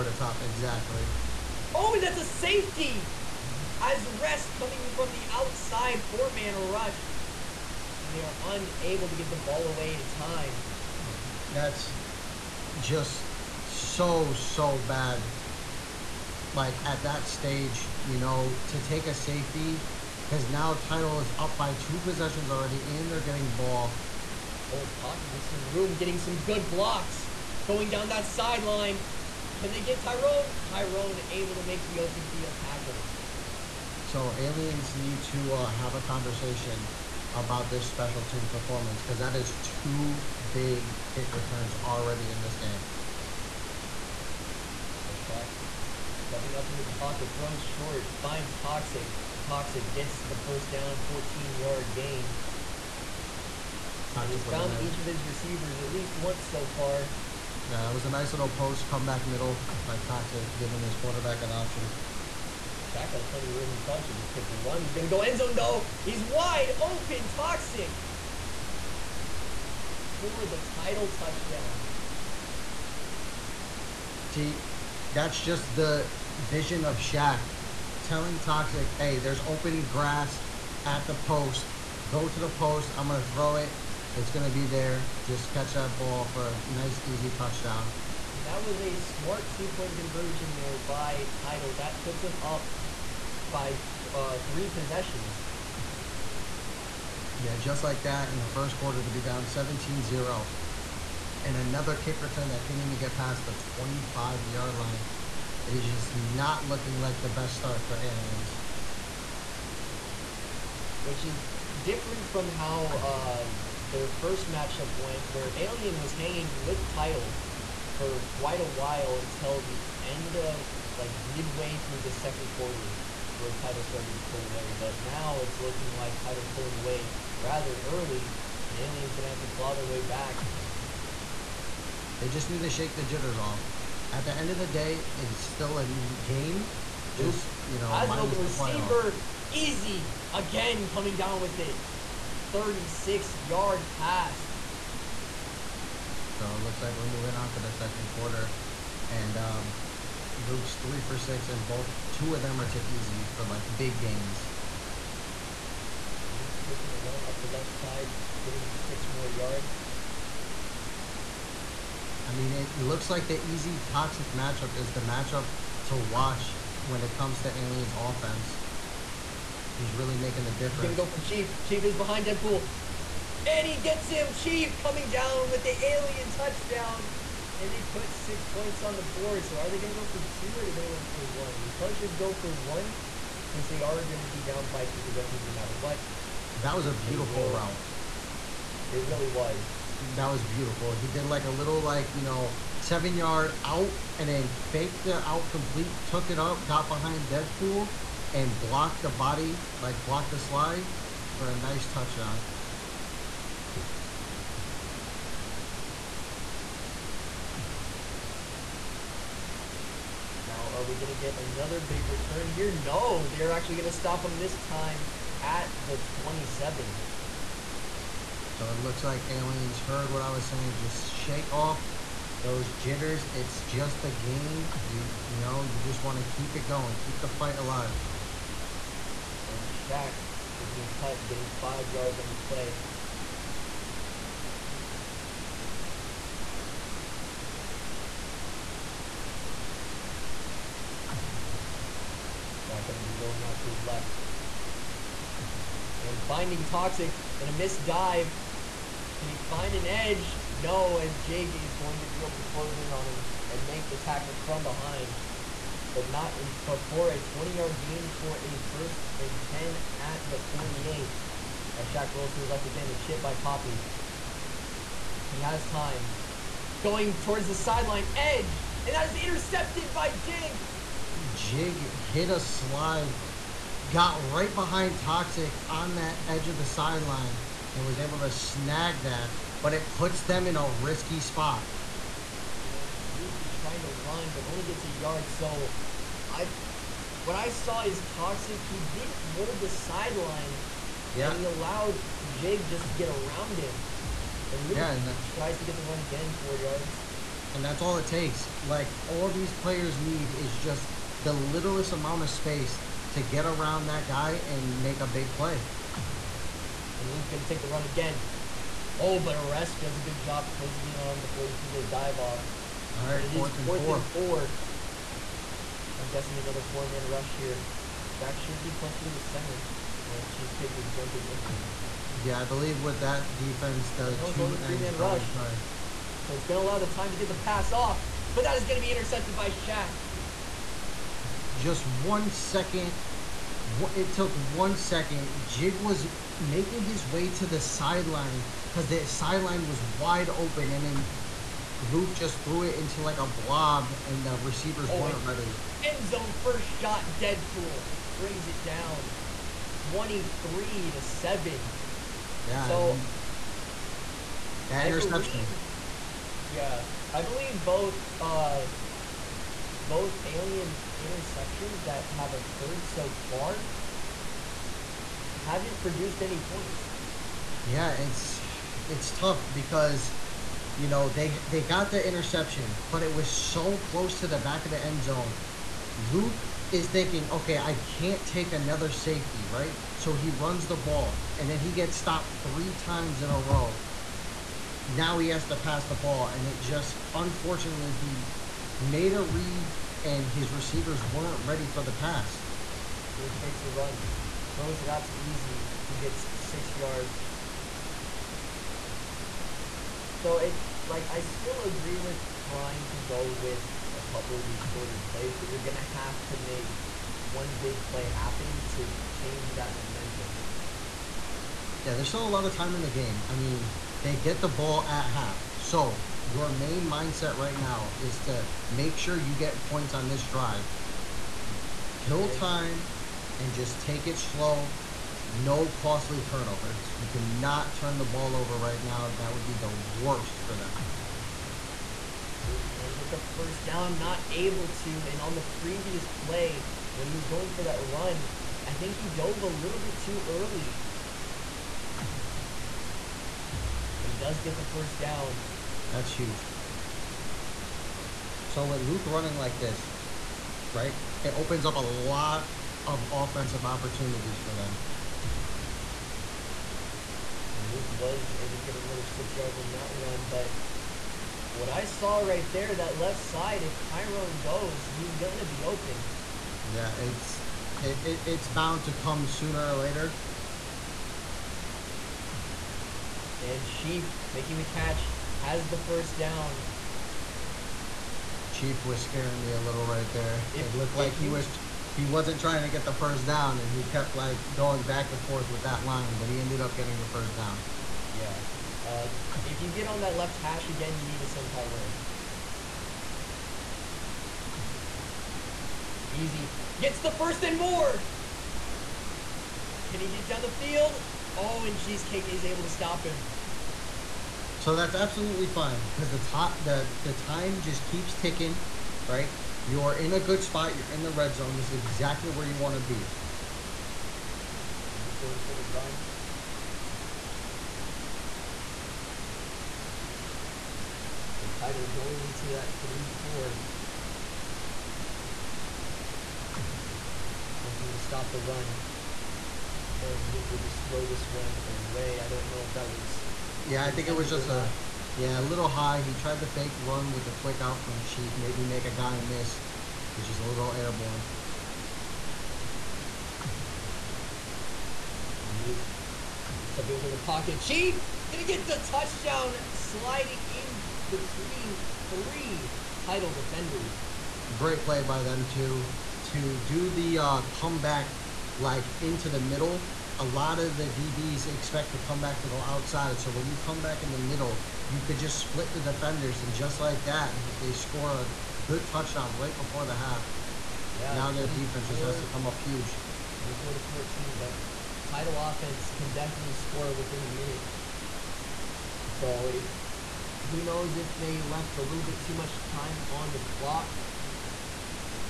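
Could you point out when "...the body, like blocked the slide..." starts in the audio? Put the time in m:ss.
3:19.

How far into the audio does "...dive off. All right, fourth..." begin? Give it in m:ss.
5:11.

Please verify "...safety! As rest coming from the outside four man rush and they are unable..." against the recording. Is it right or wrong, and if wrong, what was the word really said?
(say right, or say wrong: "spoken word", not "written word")
right.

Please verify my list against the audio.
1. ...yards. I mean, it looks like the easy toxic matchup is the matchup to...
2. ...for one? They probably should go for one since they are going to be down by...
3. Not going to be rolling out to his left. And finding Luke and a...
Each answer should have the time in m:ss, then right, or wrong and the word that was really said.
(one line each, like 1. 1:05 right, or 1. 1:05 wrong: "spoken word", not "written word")
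1. 2:39 right
2. 3:01 right
3. 4:02 wrong: "Toxic", not "Luke".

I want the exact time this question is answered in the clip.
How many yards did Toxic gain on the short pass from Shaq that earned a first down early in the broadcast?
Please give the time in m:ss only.
0:51.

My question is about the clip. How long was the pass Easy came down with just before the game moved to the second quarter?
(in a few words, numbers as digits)
36 yards.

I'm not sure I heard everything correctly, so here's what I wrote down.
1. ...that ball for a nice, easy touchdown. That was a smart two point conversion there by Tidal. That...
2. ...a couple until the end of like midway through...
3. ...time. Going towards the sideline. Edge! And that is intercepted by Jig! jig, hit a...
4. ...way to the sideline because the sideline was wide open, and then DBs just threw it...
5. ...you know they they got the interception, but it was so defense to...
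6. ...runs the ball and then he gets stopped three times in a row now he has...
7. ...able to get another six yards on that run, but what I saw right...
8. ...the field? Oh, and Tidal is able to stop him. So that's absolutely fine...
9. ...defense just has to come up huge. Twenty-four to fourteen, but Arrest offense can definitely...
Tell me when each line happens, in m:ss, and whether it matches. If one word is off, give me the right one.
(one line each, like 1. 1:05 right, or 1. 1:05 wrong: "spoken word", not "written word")
1. 1:25 right
2. 1:58 wrong: "while", not "couple"
3. 4:25 right
4. 5:37 wrong: "Luke", not "DBs"
5. 6:10 wrong: "close", not "defense"
6. 6:20 right
7. 7:38 right
8. 8:20 wrong: "Cheesecake", not "Tidal"
9. 9:31 wrong: "Tidal", not "Arrest".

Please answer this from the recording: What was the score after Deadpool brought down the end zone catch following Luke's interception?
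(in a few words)
23-7.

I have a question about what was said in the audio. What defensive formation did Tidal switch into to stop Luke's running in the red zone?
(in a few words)
Three four.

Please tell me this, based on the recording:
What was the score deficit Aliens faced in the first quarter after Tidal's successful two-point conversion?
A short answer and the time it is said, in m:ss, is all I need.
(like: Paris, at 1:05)
17-0, at 1:39.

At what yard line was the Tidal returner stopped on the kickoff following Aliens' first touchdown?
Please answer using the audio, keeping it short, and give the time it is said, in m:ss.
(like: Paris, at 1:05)
27, at 3:35.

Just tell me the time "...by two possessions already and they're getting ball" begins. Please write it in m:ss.
0:21.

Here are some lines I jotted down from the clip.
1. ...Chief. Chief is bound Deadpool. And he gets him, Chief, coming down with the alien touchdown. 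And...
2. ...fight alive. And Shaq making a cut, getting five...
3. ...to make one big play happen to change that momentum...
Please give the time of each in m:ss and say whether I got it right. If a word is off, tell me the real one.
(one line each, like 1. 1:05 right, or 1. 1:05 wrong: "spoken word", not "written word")
1. 2:51 wrong: "behind", not "bound"
2. 3:47 right
3. 6:46 right.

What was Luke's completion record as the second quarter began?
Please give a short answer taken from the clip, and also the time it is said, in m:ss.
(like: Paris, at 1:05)
3 for 6, at 2:30.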